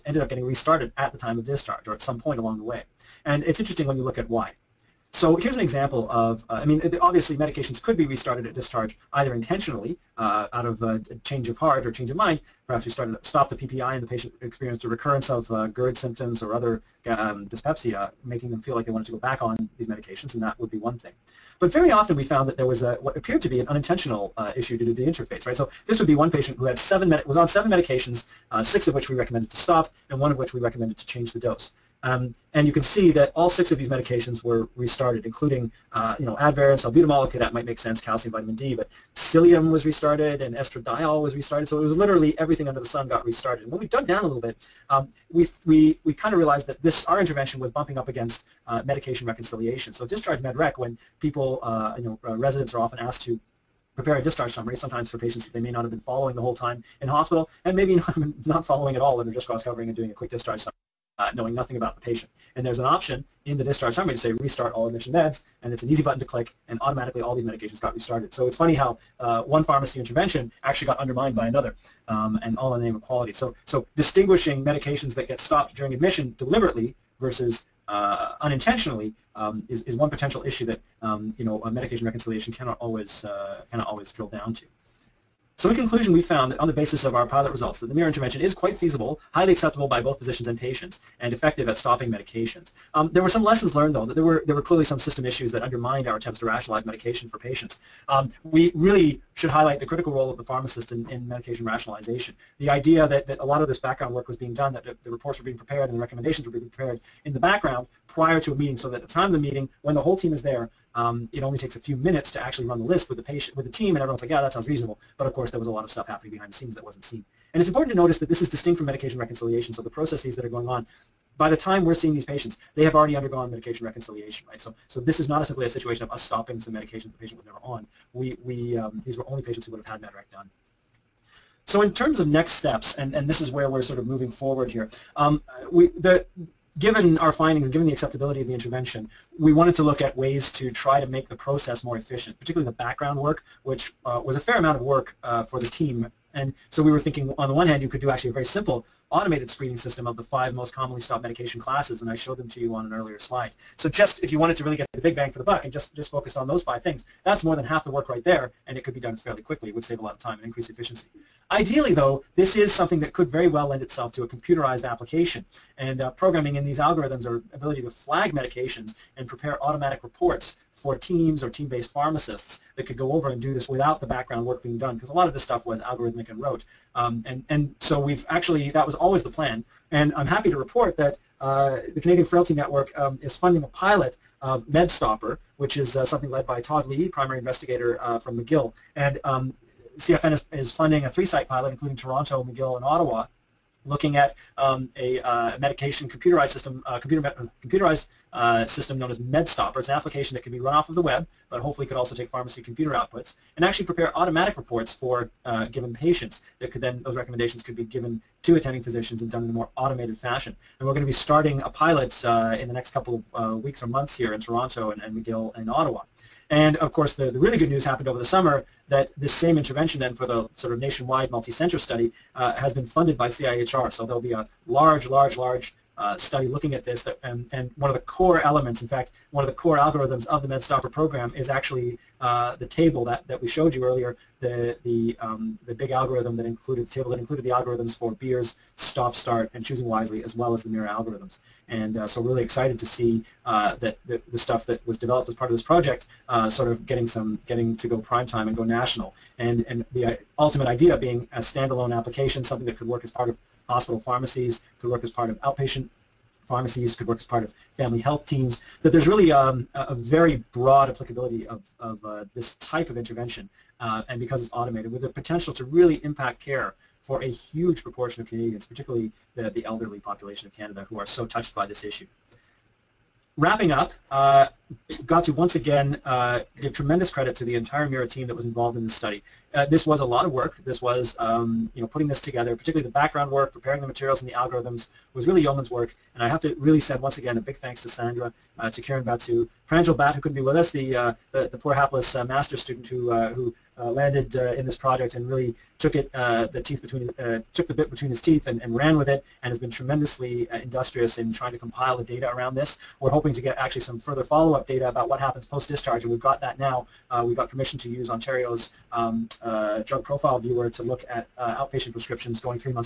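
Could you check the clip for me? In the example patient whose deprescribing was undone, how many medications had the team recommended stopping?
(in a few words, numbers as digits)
6.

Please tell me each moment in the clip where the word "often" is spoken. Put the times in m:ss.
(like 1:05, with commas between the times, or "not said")
0:21, 0:52.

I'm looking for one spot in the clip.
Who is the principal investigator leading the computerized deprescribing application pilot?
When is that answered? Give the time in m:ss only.
3:06.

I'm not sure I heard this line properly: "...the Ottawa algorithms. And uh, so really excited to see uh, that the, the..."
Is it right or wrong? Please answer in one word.
wrong.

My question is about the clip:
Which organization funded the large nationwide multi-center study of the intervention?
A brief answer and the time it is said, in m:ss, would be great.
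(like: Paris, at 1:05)
CIHR, at 3:43.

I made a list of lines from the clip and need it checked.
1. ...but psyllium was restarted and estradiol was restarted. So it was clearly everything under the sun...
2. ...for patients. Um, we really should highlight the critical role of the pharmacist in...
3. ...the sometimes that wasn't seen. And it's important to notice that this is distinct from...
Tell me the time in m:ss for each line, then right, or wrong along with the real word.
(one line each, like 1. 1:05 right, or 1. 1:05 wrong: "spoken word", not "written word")
1. 0:38 wrong: "literally", not "clearly"
2. 1:37 right
3. 1:56 wrong: "scenes", not "sometimes".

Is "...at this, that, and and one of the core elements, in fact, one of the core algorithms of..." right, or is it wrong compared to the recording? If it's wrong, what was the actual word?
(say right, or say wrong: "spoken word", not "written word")
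right.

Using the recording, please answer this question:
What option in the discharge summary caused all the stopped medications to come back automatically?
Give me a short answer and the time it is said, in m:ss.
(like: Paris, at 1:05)
Restart all admission meds, at 1:04.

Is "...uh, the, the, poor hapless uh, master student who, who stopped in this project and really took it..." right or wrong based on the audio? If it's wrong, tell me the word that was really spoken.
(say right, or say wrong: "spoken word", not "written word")
wrong: "landed", not "stopped".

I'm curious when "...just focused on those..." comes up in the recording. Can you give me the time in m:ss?
2:35.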